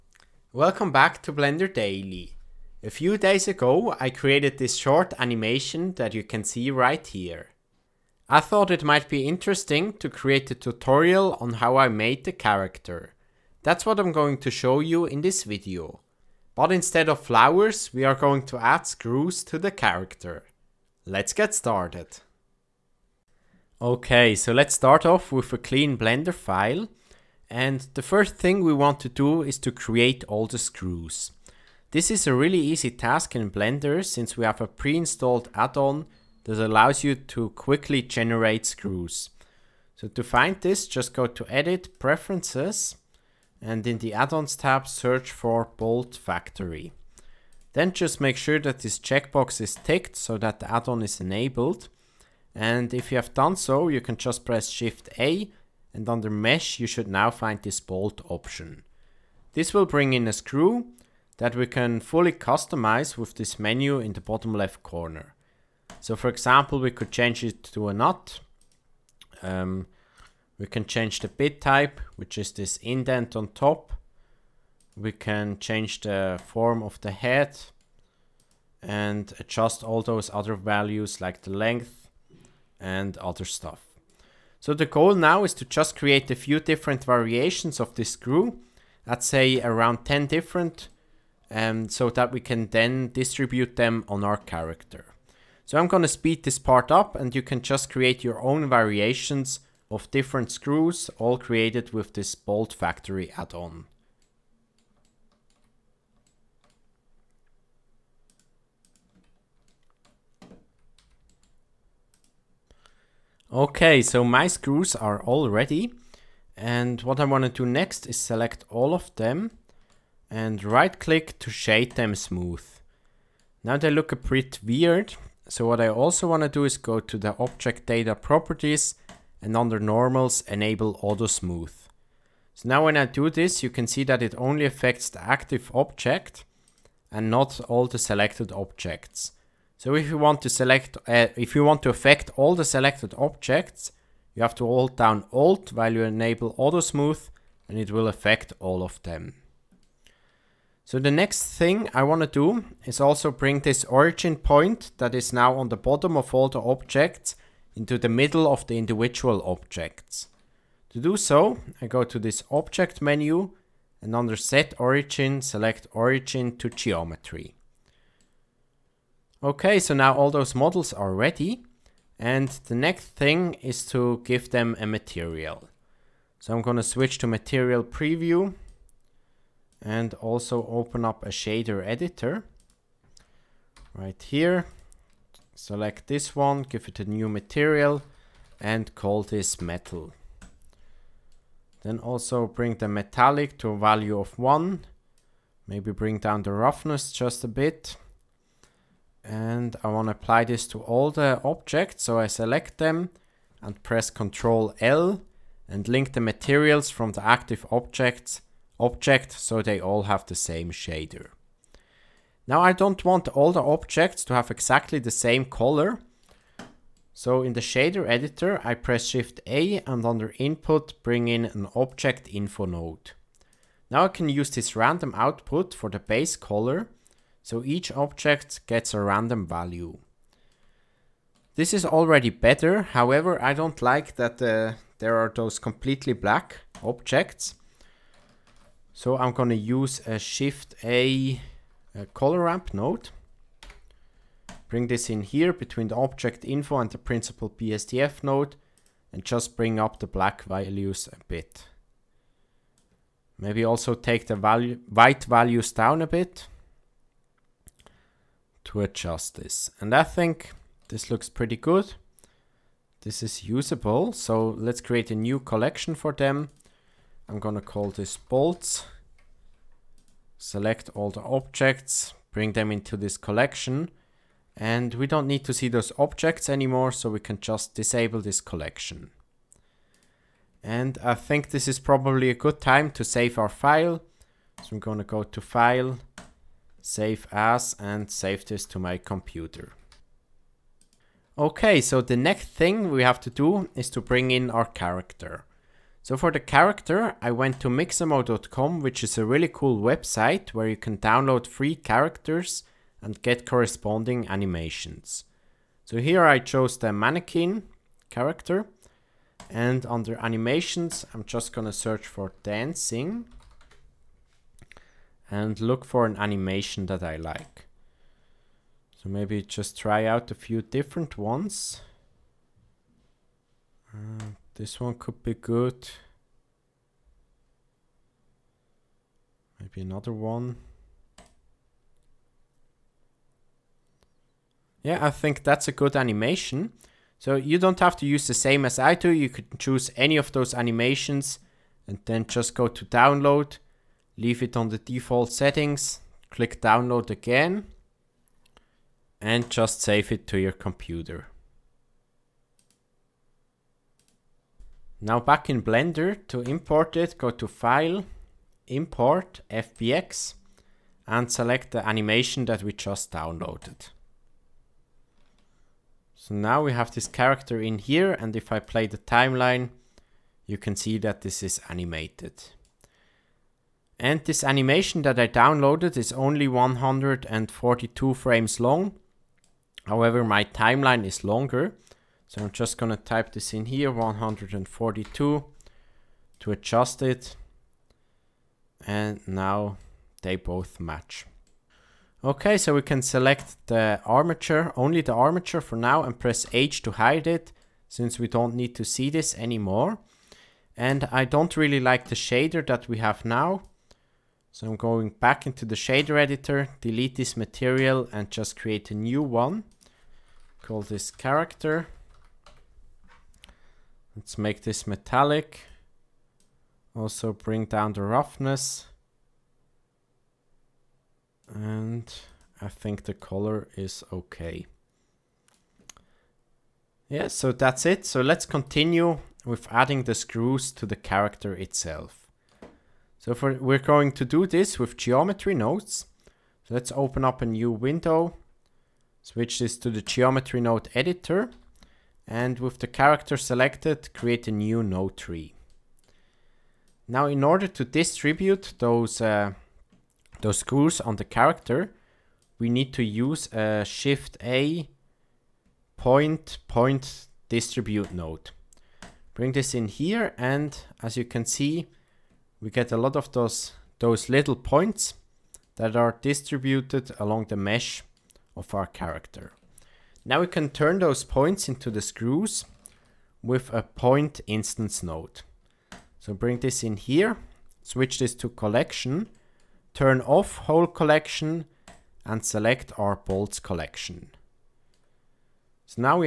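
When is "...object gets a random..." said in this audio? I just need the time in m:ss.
3:47.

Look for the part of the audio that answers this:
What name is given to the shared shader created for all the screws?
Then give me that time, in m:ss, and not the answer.
3:09.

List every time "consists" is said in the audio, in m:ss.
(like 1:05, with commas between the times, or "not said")
not said.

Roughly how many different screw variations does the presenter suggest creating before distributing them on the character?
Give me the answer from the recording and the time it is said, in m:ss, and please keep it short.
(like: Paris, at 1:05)
10, at 1:30.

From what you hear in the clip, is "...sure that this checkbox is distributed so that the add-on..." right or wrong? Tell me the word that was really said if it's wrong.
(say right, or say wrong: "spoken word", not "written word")
wrong: "ticked", not "distributed".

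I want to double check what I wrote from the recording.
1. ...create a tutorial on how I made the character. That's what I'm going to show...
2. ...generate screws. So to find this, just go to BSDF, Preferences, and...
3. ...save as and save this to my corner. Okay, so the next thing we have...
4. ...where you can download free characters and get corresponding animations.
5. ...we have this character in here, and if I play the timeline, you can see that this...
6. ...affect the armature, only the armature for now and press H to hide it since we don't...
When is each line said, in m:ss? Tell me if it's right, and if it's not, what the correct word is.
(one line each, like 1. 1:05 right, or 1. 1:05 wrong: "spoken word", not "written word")
1. 0:10 right
2. 0:38 wrong: "Edit", not "BSDF"
3. 4:46 wrong: "computer", not "corner"
4. 5:00 right
5. 6:06 right
6. 6:33 wrong: "select", not "affect".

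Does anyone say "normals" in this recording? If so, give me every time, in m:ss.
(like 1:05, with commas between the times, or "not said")
2:09.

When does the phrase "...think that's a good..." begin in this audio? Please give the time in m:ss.
5:35.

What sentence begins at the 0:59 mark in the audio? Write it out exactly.
This will bring in a screw that we can fully customize with this menu in the bottom left corner.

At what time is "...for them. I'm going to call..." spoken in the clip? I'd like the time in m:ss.
4:25.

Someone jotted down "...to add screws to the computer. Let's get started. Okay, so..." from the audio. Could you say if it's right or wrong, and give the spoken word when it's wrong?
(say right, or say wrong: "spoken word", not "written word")
wrong: "character", not "computer".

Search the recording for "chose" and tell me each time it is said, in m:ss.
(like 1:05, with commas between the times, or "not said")
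5:06.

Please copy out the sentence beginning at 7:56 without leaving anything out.
So bring this in here, switch this to collection, turn off whole collection and select our bolts collection.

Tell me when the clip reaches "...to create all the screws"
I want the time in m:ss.
0:29.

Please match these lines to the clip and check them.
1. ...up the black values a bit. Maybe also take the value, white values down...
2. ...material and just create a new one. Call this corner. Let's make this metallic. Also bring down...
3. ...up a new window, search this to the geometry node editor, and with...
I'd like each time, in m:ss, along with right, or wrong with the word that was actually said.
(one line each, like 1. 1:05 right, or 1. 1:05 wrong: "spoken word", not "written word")
1. 4:09 right
2. 6:47 wrong: "character", not "corner"
3. 7:17 wrong: "switch", not "search".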